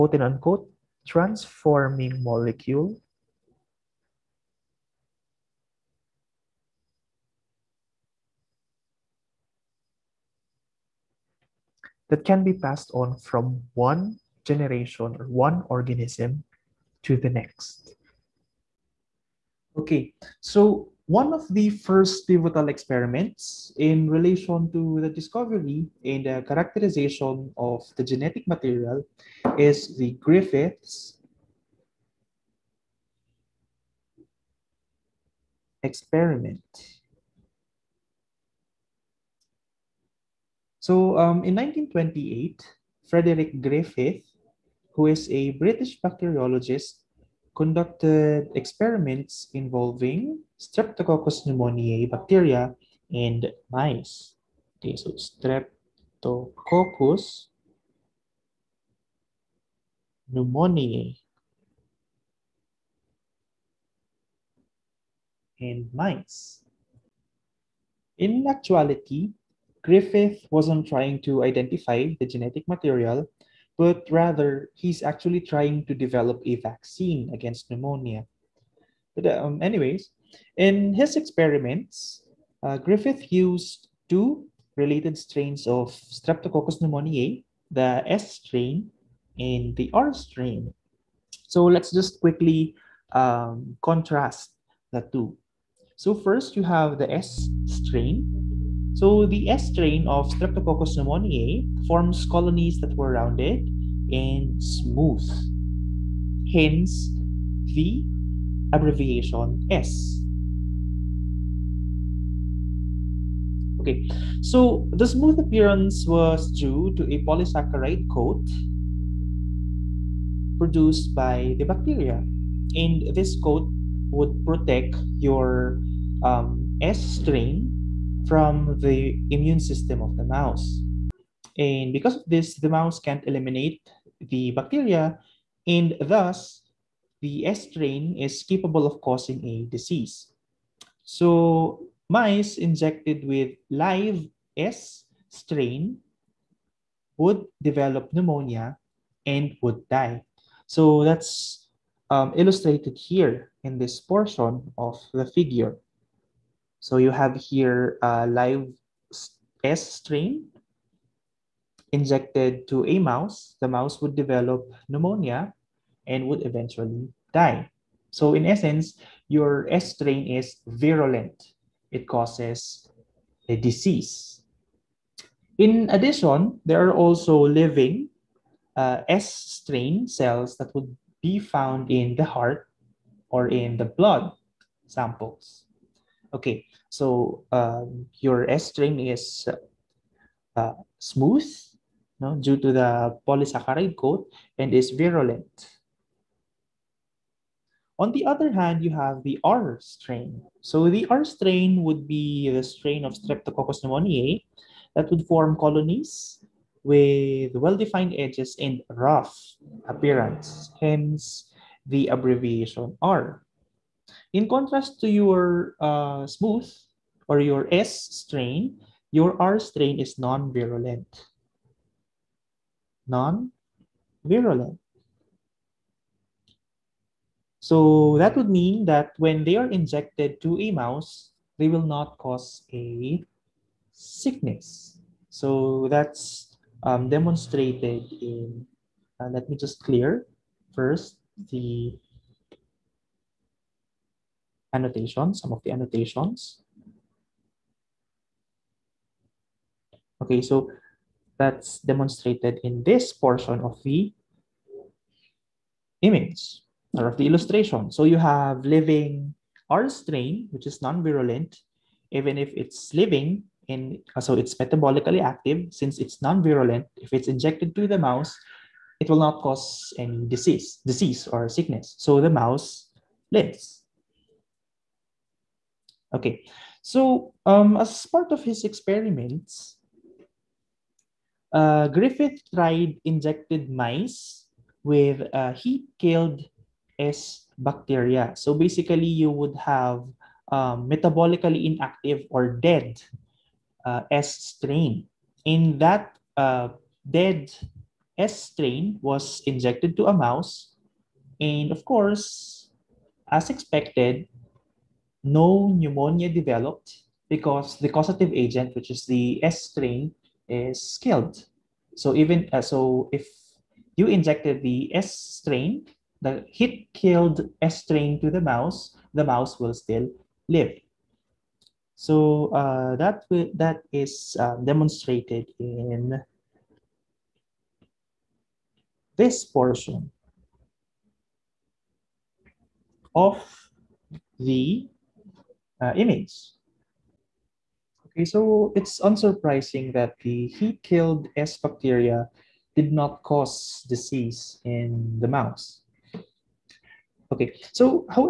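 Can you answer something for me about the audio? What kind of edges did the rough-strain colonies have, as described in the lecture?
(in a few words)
Well-defined edges.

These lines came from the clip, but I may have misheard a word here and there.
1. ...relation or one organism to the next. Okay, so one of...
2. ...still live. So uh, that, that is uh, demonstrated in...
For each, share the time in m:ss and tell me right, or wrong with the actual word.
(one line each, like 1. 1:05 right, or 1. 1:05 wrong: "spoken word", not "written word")
1. 0:14 wrong: "generation", not "relation"
2. 5:19 right.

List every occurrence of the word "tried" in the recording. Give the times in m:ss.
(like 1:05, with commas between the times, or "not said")
4:42.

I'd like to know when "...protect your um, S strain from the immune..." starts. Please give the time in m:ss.
2:04.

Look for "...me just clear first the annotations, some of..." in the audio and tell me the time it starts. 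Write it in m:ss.
3:59.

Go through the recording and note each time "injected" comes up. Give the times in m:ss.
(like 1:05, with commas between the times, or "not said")
2:22, 2:41, 3:49, 4:27, 4:43, 4:59, 5:14.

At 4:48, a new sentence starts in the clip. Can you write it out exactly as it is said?
So basically, you would have um, metabolically inactive or dead uh, S strain.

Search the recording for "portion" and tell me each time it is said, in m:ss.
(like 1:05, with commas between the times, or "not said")
2:33, 4:13, 5:29.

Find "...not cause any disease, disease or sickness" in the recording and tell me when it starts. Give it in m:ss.
4:29.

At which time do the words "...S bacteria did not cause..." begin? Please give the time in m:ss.
5:41.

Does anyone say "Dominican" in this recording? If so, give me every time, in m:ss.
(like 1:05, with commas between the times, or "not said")
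not said.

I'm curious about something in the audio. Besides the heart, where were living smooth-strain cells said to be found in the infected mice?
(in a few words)
Blood samples.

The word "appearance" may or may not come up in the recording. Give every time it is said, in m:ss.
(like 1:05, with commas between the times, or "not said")
1:55, 3:29.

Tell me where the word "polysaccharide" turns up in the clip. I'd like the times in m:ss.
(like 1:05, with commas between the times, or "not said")
1:57, 3:13.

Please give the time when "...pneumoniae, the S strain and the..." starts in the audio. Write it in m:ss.
1:26.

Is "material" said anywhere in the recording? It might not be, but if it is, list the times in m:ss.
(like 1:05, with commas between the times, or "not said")
0:28, 1:12.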